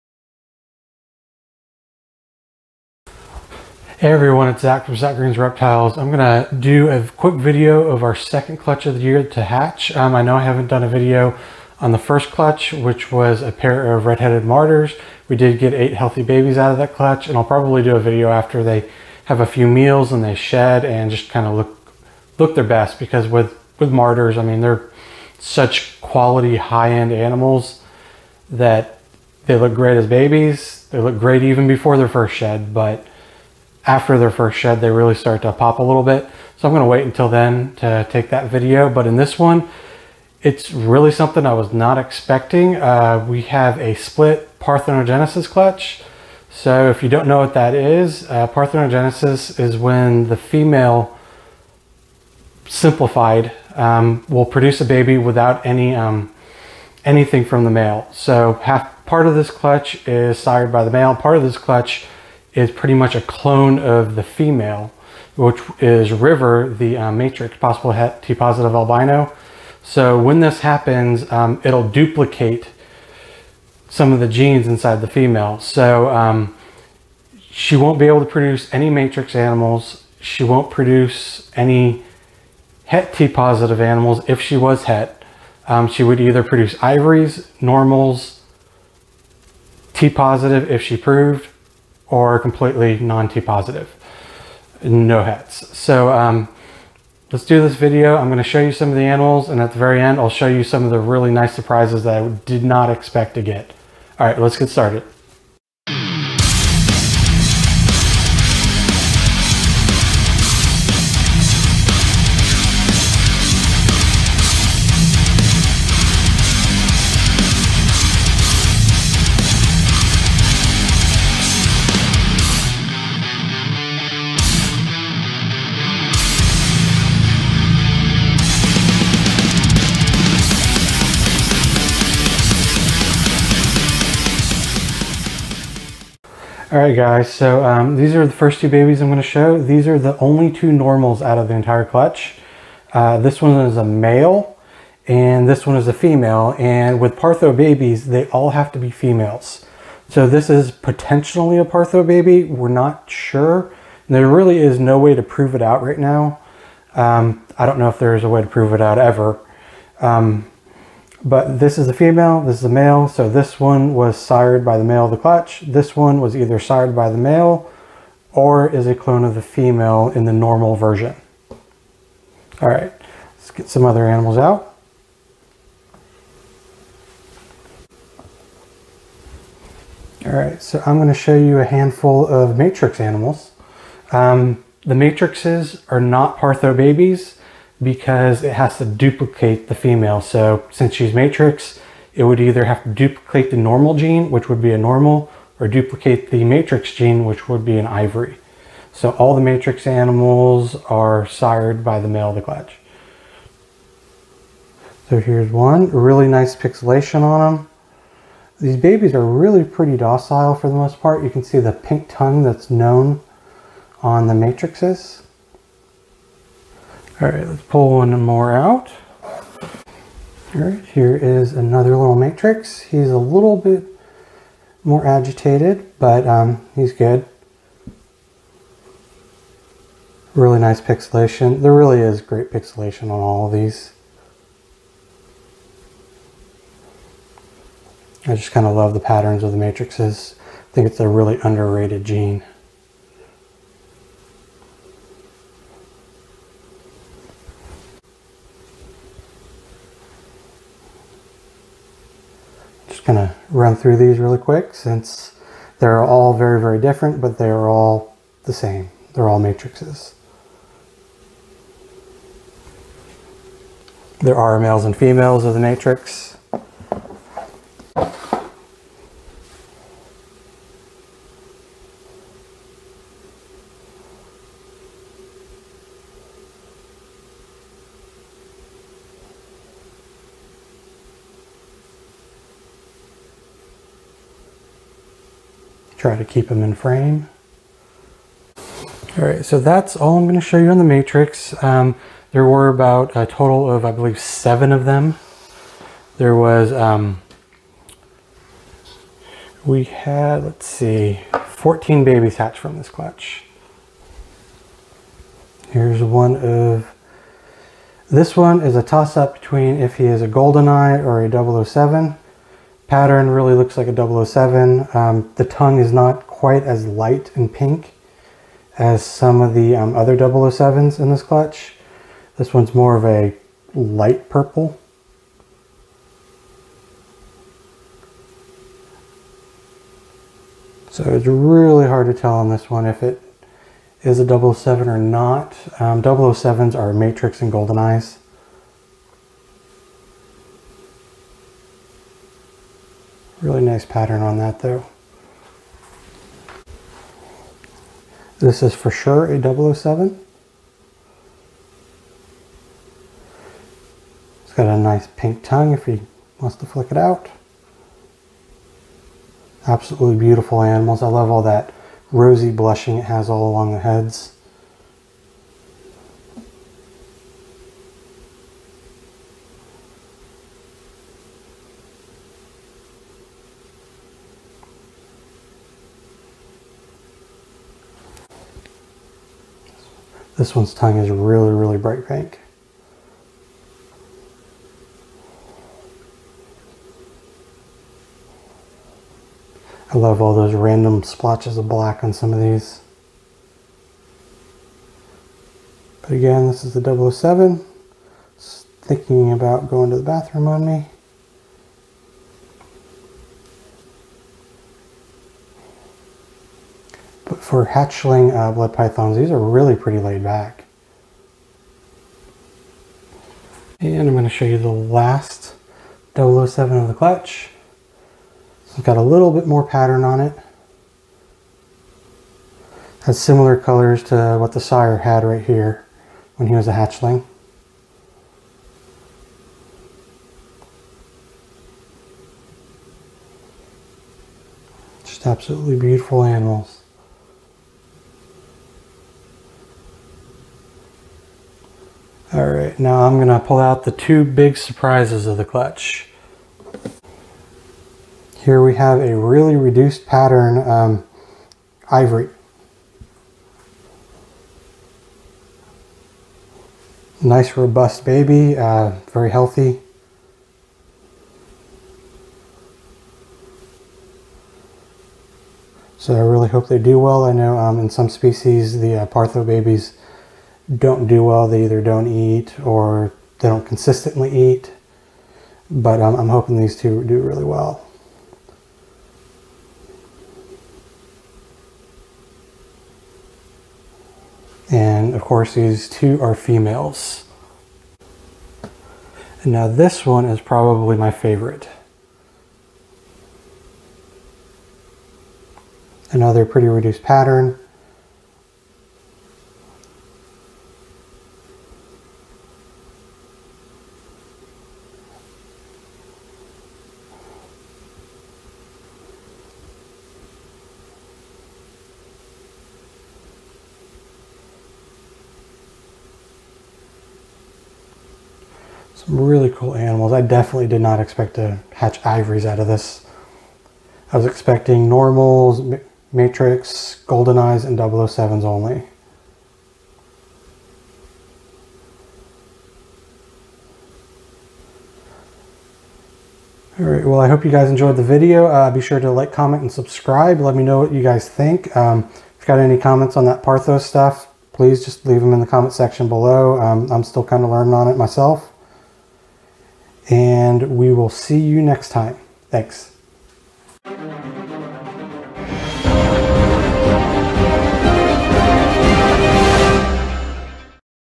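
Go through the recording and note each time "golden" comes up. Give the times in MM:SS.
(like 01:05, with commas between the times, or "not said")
05:10, 05:37, 08:47.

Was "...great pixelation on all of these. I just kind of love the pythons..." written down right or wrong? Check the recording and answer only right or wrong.
wrong.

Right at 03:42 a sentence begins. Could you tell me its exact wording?
He's a little bit more agitated, but um, he's good.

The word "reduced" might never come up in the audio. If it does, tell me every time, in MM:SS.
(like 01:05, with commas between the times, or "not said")
07:29, 08:16.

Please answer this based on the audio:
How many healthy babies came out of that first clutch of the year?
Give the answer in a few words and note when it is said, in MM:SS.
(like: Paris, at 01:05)
8, at 00:15.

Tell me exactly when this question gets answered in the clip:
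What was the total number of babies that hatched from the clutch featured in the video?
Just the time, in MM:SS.
05:01.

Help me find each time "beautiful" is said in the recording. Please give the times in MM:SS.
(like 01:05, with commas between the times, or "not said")
06:00, 07:15.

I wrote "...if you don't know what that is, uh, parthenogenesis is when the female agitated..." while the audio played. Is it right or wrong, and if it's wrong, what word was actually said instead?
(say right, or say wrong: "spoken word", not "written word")
wrong: "simplified", not "agitated".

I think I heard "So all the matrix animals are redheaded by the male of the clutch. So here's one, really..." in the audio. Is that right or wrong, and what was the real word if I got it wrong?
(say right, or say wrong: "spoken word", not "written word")
wrong: "sired", not "redheaded".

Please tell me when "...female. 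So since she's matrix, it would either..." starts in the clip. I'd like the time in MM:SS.
03:09.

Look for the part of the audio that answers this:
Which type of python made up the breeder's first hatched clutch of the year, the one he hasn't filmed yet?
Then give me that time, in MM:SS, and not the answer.
00:14.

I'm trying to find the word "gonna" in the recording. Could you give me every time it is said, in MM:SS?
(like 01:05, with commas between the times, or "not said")
00:06, 00:36, 01:38, 02:19, 04:50, 07:23.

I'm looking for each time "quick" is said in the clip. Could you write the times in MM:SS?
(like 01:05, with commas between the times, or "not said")
00:07, 04:14.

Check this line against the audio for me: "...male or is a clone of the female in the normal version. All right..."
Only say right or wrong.
right.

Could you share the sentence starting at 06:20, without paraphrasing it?
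This one's tongue is really, really bright pink.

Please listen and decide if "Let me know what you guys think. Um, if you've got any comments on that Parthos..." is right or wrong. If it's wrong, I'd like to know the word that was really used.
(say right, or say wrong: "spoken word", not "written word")
right.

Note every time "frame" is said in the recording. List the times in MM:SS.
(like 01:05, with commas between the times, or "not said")
04:46.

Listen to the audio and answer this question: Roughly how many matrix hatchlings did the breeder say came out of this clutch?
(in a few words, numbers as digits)
7.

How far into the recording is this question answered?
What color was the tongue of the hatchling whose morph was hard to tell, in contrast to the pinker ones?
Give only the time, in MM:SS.
05:23.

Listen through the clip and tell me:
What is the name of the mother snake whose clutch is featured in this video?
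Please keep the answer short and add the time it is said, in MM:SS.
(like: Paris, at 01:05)
River, at 01:06.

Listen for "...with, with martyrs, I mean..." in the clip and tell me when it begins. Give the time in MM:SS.
00:23.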